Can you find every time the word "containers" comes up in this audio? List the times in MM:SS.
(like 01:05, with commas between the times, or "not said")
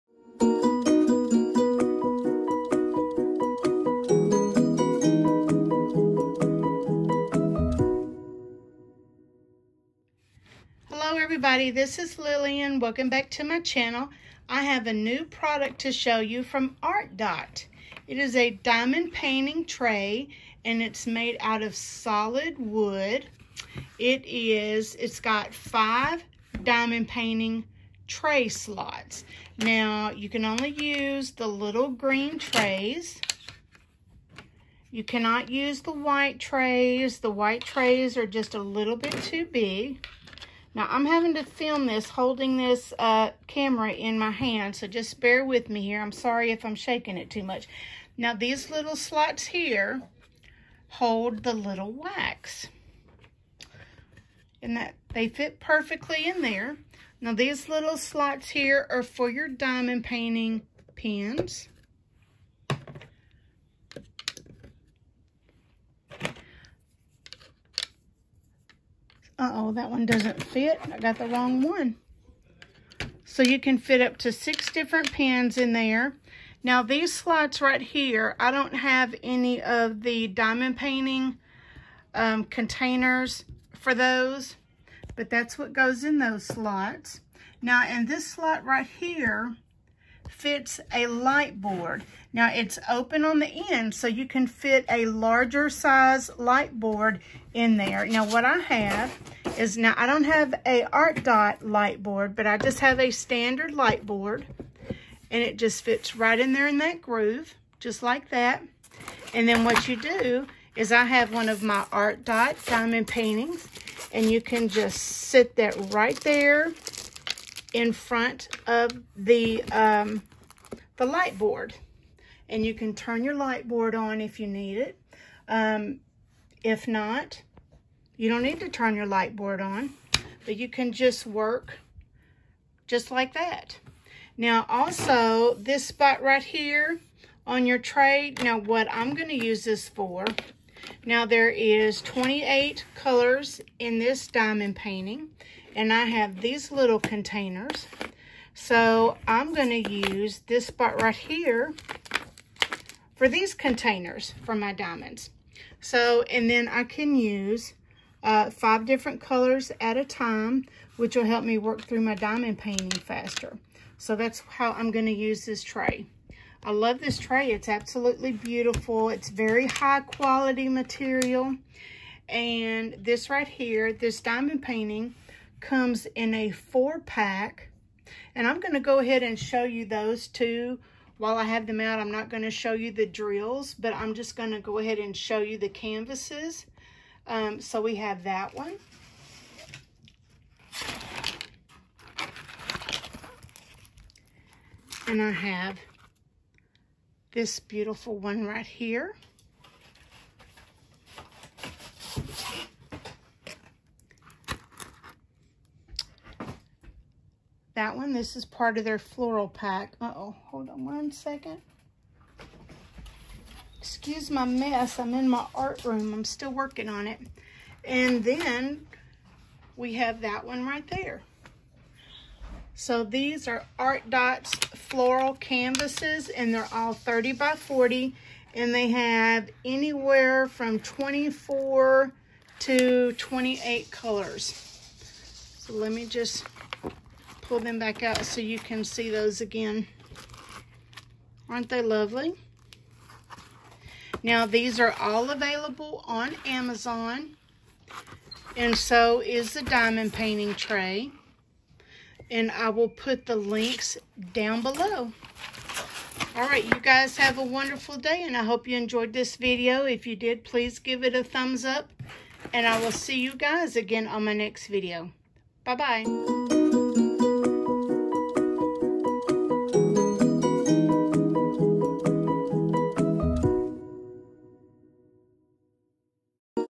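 01:22, 02:26, 02:33.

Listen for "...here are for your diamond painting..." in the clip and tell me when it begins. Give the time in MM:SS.
00:58.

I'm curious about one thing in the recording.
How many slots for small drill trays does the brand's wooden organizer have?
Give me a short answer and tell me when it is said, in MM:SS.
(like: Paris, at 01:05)
5, at 00:25.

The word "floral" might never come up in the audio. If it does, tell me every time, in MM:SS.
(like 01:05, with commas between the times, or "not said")
03:28, 03:44.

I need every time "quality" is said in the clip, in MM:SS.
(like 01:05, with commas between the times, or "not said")
02:50.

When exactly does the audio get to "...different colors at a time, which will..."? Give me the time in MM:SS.
02:38.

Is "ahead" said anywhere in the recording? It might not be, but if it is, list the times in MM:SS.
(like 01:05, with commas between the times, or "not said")
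02:58, 03:04.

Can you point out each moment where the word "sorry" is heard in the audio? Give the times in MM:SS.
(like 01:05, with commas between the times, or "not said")
00:46.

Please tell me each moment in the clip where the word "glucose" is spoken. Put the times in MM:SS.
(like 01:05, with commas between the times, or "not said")
not said.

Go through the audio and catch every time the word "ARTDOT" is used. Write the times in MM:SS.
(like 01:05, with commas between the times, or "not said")
00:16, 01:40, 01:51, 03:43.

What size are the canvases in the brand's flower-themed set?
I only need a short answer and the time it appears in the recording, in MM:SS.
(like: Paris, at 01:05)
30 by 40, at 03:46.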